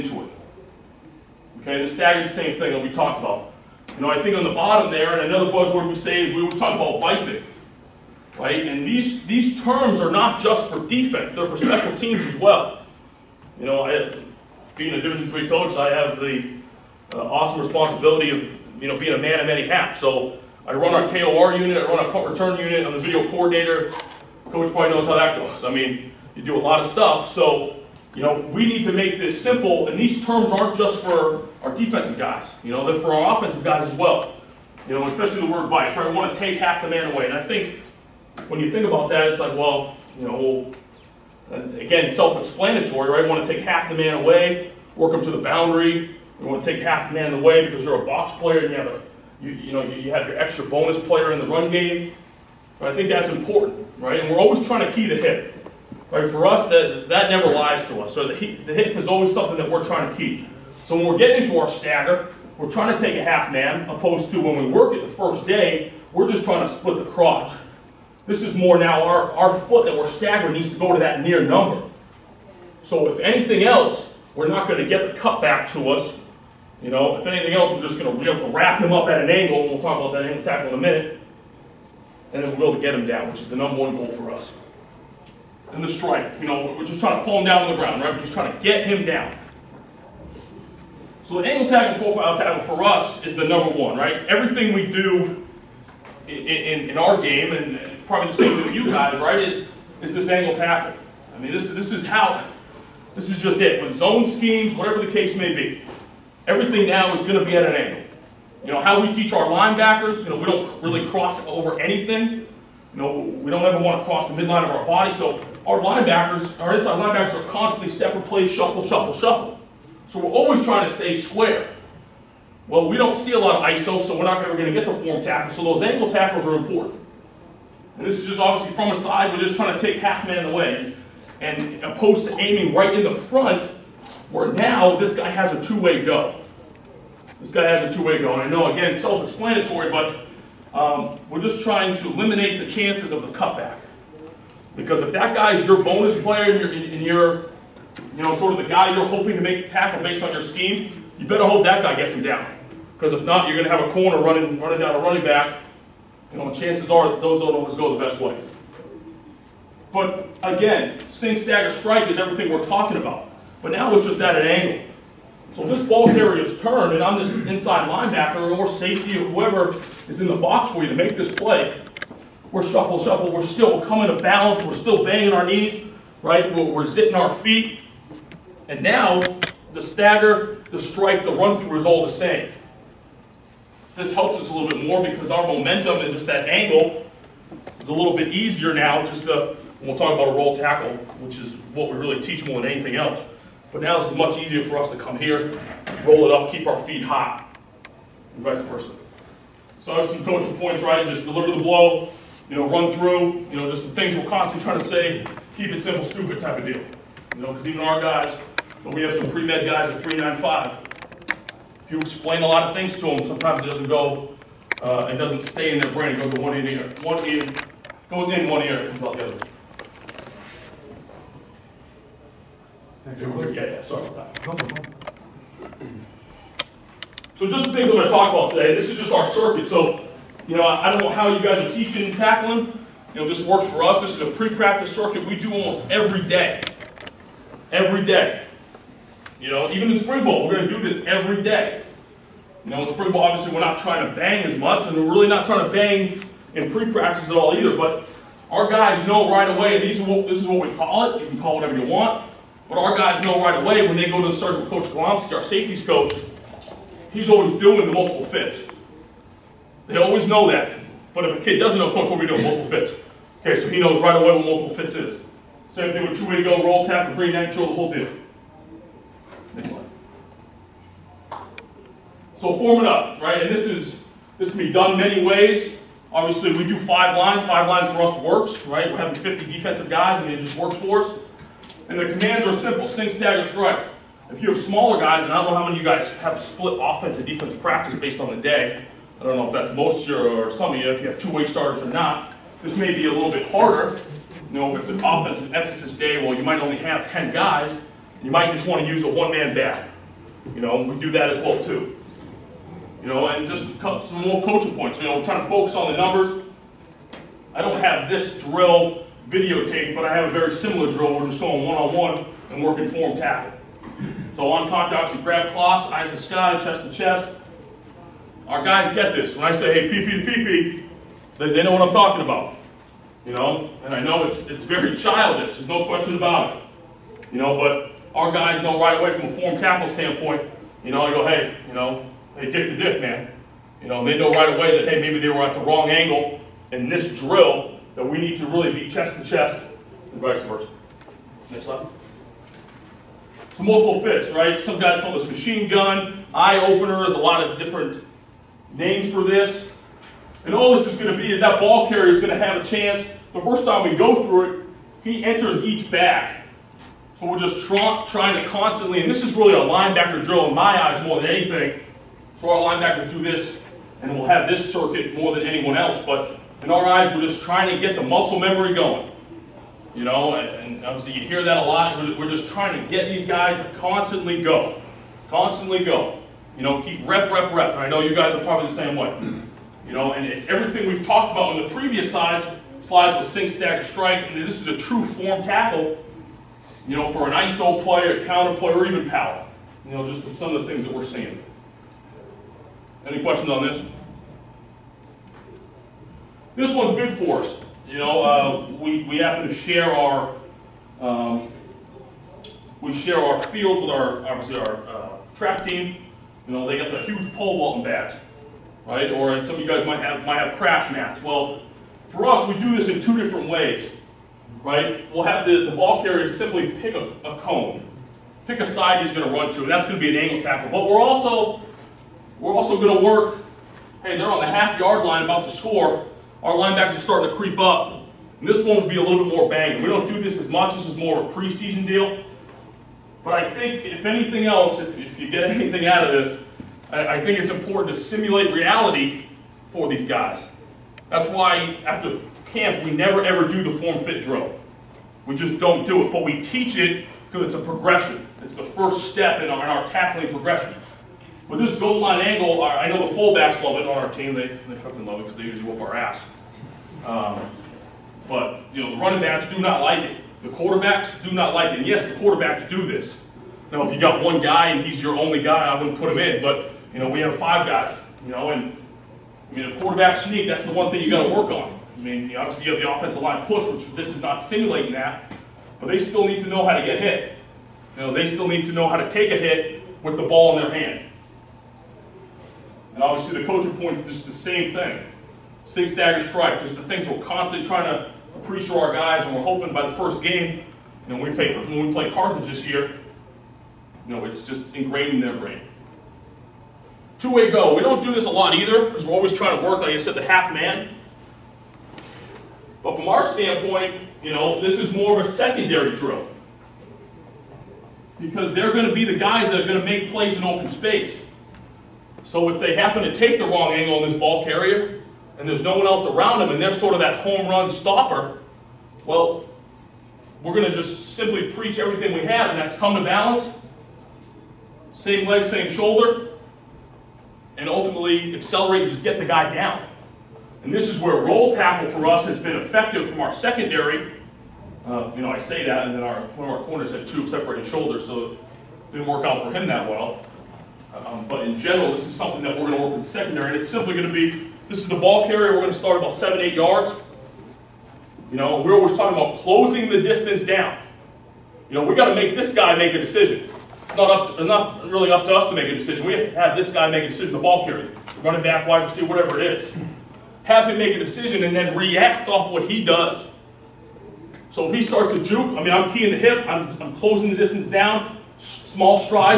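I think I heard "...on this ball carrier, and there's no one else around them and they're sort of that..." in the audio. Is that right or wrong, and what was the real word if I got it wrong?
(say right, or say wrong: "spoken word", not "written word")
right.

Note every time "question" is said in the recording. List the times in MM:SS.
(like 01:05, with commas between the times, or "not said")
05:25, 06:33.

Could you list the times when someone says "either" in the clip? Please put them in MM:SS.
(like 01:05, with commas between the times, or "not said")
04:07, 08:18.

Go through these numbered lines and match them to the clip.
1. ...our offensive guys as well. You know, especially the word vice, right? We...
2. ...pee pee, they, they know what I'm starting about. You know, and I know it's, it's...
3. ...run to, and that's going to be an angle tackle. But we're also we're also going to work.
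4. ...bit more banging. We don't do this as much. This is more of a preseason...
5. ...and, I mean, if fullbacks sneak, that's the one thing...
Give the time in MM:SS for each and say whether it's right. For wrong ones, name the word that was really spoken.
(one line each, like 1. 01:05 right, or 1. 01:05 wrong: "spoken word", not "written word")
1. 00:33 right
2. 05:20 wrong: "talking", not "starting"
3. 06:59 right
4. 07:09 right
5. 07:48 wrong: "quarterbacks", not "fullbacks".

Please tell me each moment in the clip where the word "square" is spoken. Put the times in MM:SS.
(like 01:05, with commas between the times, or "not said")
02:01.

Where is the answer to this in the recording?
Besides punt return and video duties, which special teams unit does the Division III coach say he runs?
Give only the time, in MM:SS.
00:21.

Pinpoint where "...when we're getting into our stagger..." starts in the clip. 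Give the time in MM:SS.
01:00.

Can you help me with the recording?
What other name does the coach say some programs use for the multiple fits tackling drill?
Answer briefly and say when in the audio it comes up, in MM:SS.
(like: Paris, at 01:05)
Machine gun, at 05:45.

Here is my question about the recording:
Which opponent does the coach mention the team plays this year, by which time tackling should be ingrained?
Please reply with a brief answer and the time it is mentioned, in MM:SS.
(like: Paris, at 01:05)
Carthage, at 08:12.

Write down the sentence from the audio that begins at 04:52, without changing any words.
This may be a little bit harder.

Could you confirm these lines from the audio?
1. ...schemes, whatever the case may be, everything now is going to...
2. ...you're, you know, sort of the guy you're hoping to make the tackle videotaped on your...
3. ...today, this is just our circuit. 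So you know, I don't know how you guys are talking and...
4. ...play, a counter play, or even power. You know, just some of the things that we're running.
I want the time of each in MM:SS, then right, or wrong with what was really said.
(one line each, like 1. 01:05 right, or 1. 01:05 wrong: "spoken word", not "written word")
1. 01:44 right
2. 02:27 wrong: "based", not "videotaped"
3. 03:48 wrong: "teaching", not "talking"
4. 06:27 wrong: "seeing", not "running".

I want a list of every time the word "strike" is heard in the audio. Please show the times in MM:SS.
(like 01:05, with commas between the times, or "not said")
01:25, 02:41, 03:00, 04:43, 06:23, 08:06.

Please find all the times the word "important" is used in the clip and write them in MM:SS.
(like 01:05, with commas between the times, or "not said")
00:53, 02:06, 07:17.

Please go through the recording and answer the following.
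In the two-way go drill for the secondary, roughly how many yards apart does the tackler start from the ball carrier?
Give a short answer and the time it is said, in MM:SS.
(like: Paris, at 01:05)
7 to 8 yards, at 09:06.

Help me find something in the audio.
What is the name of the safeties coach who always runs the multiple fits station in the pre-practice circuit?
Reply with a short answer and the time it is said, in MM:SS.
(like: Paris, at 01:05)
Coach Golomsky, at 04:14.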